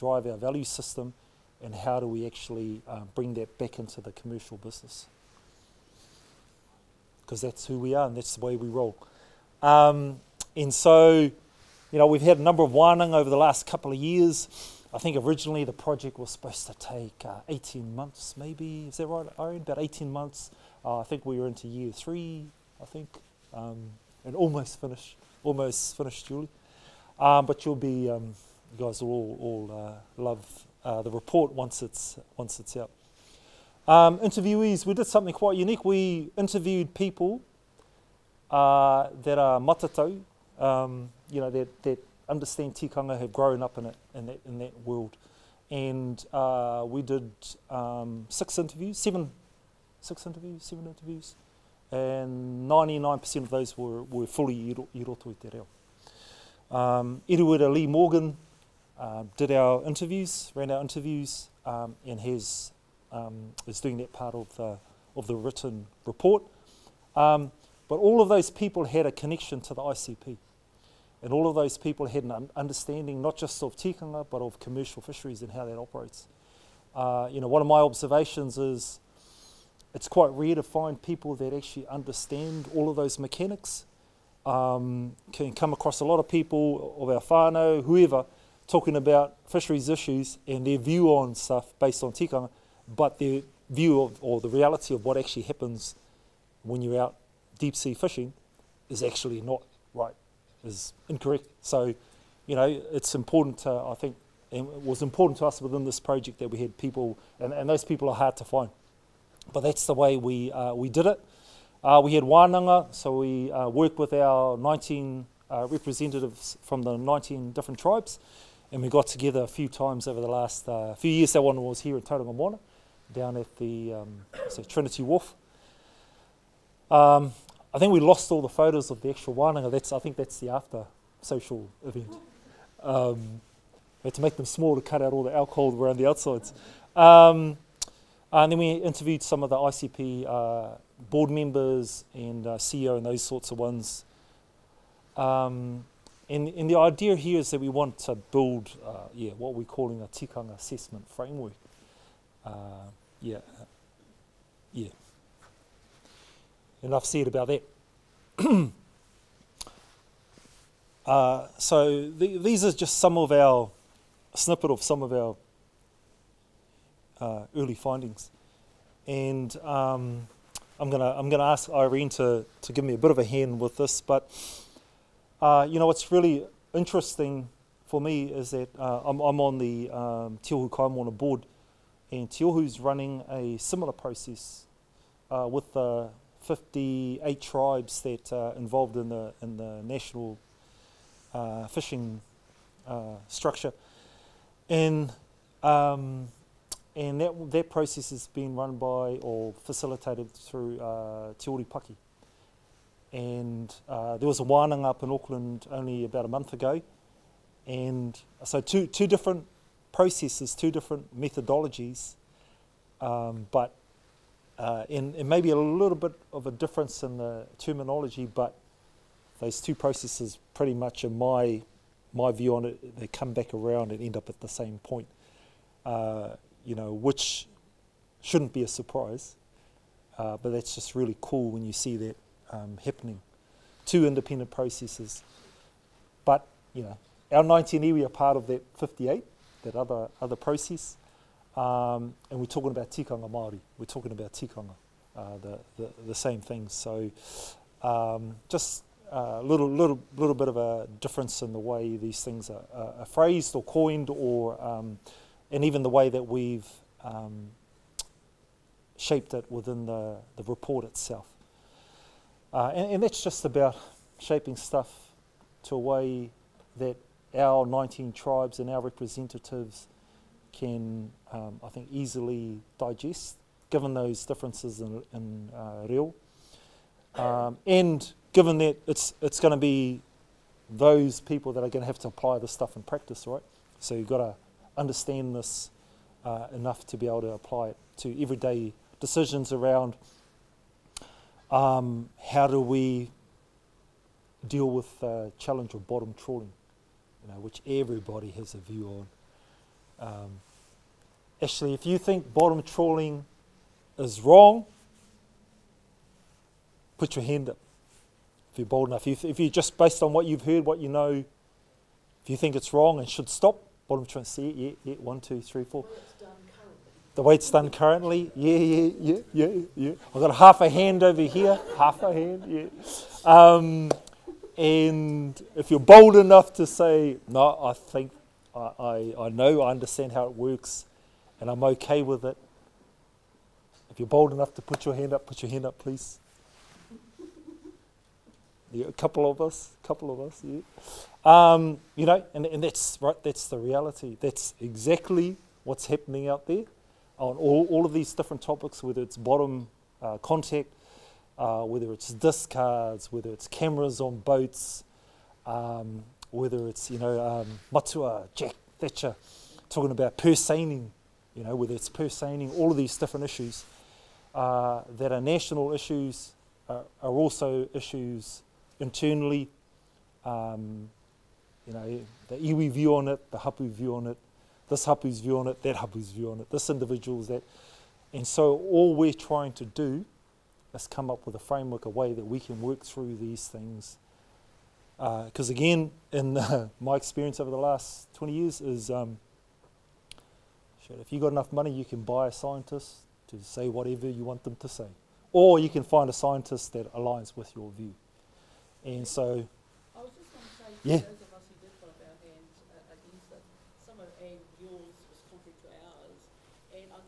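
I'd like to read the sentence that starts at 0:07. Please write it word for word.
Because that's who we are, and that's the way we roll.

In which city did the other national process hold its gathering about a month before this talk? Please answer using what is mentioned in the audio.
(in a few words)
Auckland.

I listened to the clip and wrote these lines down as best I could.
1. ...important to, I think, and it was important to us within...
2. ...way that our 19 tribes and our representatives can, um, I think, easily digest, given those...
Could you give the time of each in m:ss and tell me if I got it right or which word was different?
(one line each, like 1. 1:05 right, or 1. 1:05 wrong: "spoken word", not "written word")
1. 1:43 right
2. 4:25 right.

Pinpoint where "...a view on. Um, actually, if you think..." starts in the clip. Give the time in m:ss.
4:58.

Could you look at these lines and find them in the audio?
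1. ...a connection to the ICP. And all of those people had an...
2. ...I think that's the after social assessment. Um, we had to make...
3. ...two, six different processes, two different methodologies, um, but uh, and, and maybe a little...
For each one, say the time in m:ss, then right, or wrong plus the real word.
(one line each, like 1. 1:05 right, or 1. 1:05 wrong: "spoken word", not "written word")
1. 1:09 right
2. 2:09 wrong: "event", not "assessment"
3. 3:28 wrong: "two", not "six".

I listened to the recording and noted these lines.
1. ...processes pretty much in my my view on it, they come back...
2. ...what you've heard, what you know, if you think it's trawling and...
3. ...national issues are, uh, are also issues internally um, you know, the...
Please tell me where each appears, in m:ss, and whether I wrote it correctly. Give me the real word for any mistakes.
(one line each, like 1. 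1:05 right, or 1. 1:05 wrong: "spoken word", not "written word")
1. 3:39 right
2. 5:10 wrong: "wrong", not "trawling"
3. 6:05 right.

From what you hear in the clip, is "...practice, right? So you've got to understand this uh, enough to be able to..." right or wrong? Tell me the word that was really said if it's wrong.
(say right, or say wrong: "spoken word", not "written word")
right.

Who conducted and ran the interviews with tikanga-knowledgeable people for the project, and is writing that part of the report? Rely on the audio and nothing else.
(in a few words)
Iruera Lee Morgan.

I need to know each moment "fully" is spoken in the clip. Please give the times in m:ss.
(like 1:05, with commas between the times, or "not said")
0:54.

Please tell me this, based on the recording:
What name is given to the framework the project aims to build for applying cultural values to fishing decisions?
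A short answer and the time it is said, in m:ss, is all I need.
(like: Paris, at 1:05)
tikanga assessment framework, at 2:30.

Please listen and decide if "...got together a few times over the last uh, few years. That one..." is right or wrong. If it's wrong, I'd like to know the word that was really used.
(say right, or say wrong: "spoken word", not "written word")
right.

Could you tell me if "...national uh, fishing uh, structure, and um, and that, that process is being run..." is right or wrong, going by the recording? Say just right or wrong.
right.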